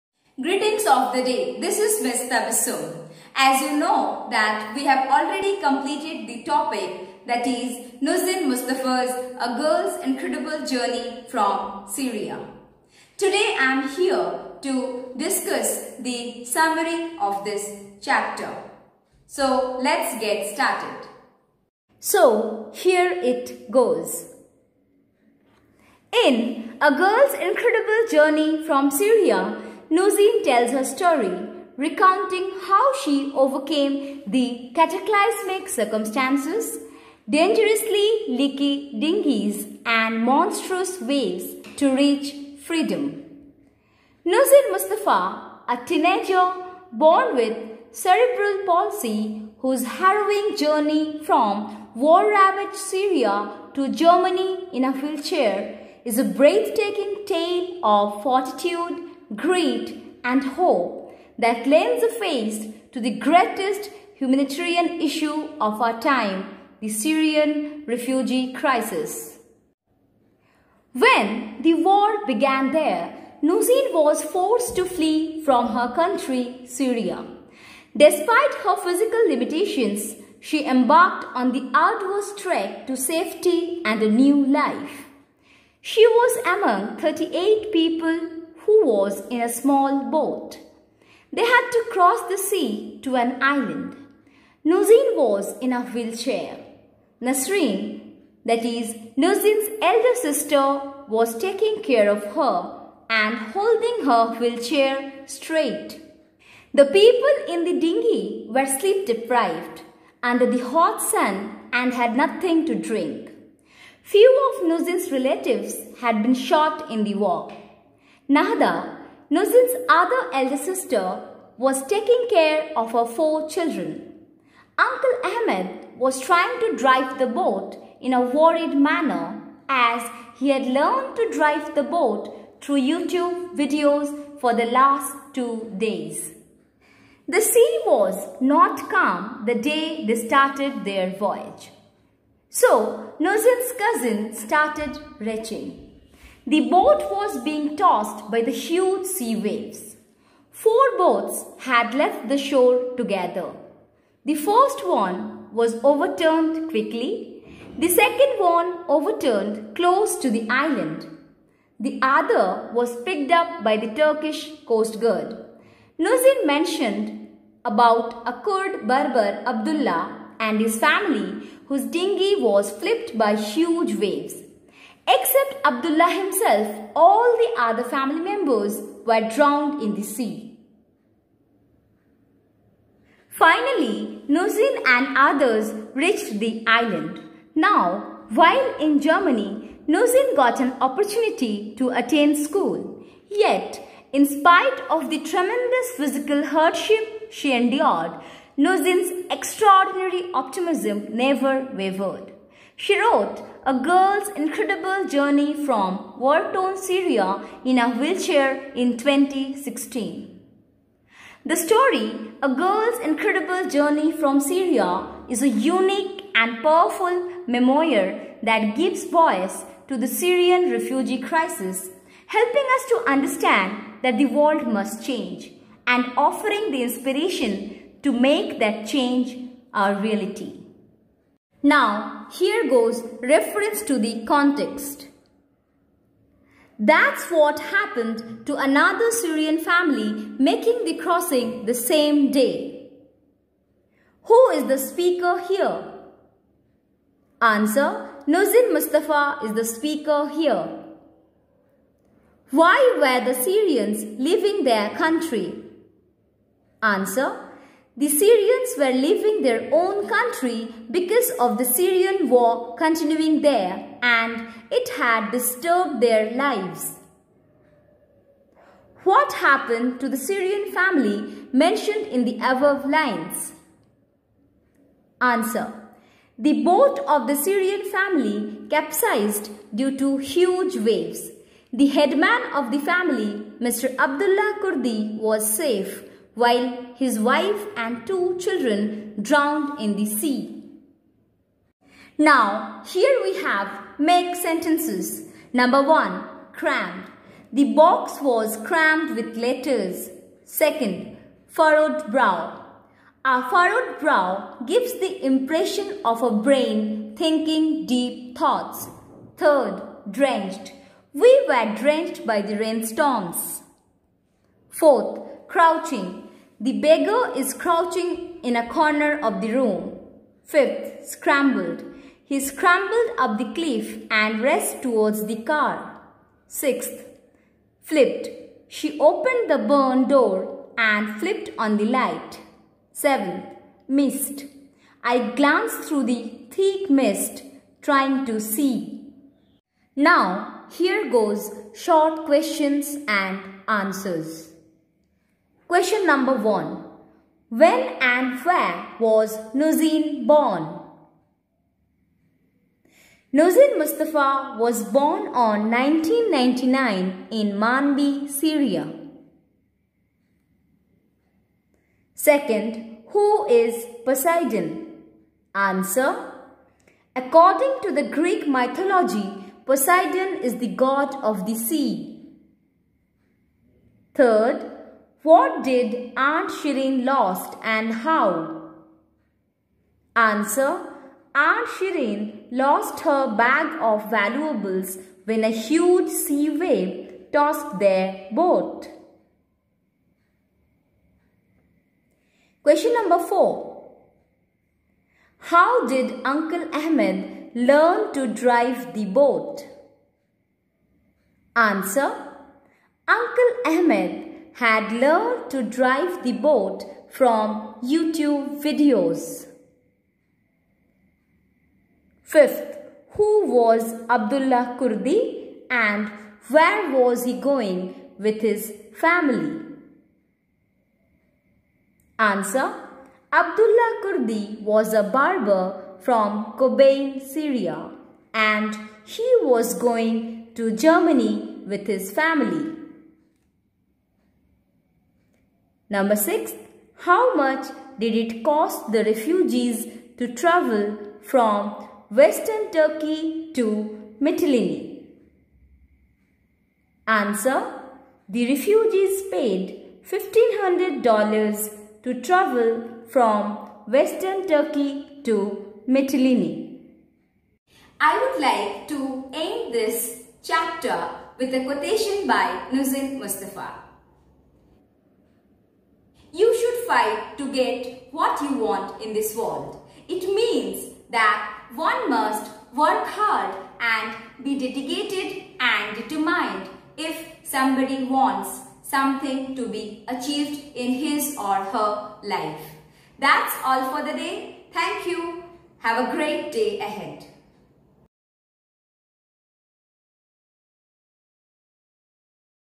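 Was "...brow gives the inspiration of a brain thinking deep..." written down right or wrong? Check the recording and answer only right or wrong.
wrong.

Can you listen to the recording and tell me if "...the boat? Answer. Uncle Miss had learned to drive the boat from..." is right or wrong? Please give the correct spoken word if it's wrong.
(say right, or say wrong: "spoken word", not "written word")
wrong: "Ahmed", not "Miss".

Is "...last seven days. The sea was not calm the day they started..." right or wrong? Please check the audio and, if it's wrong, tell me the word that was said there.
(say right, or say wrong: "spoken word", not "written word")
wrong: "two", not "seven".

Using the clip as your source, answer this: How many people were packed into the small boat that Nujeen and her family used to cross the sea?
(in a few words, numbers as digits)
38.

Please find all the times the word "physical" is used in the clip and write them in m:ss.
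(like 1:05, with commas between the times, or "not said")
1:18, 3:15.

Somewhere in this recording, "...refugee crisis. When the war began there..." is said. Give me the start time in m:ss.
1:07.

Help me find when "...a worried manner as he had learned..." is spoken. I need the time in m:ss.
2:08.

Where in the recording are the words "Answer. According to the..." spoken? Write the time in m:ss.
6:05.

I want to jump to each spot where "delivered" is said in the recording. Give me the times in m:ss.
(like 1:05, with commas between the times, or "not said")
not said.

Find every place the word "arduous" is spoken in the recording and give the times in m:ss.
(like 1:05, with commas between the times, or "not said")
1:21.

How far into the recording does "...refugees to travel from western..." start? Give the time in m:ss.
7:19.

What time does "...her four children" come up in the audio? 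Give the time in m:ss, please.
2:02.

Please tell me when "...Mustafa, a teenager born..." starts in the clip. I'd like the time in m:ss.
0:44.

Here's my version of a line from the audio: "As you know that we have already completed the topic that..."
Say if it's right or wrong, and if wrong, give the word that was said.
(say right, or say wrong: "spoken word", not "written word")
right.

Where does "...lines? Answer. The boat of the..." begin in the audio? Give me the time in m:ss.
4:32.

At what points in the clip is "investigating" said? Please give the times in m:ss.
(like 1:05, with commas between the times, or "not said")
not said.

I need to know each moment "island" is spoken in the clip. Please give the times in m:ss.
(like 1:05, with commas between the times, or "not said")
1:33, 2:40, 3:06.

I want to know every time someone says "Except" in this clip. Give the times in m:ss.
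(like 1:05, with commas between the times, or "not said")
2:55.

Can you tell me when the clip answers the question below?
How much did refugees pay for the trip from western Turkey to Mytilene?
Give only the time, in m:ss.
7:30.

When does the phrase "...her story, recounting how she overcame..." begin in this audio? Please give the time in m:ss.
0:30.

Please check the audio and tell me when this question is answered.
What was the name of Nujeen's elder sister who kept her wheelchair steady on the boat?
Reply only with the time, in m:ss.
1:37.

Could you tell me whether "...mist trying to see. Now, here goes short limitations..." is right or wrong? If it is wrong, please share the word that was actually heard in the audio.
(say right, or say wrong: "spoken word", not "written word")
wrong: "questions", not "limitations".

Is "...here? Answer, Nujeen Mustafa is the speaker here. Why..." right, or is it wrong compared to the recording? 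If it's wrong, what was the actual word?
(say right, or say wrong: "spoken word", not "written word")
right.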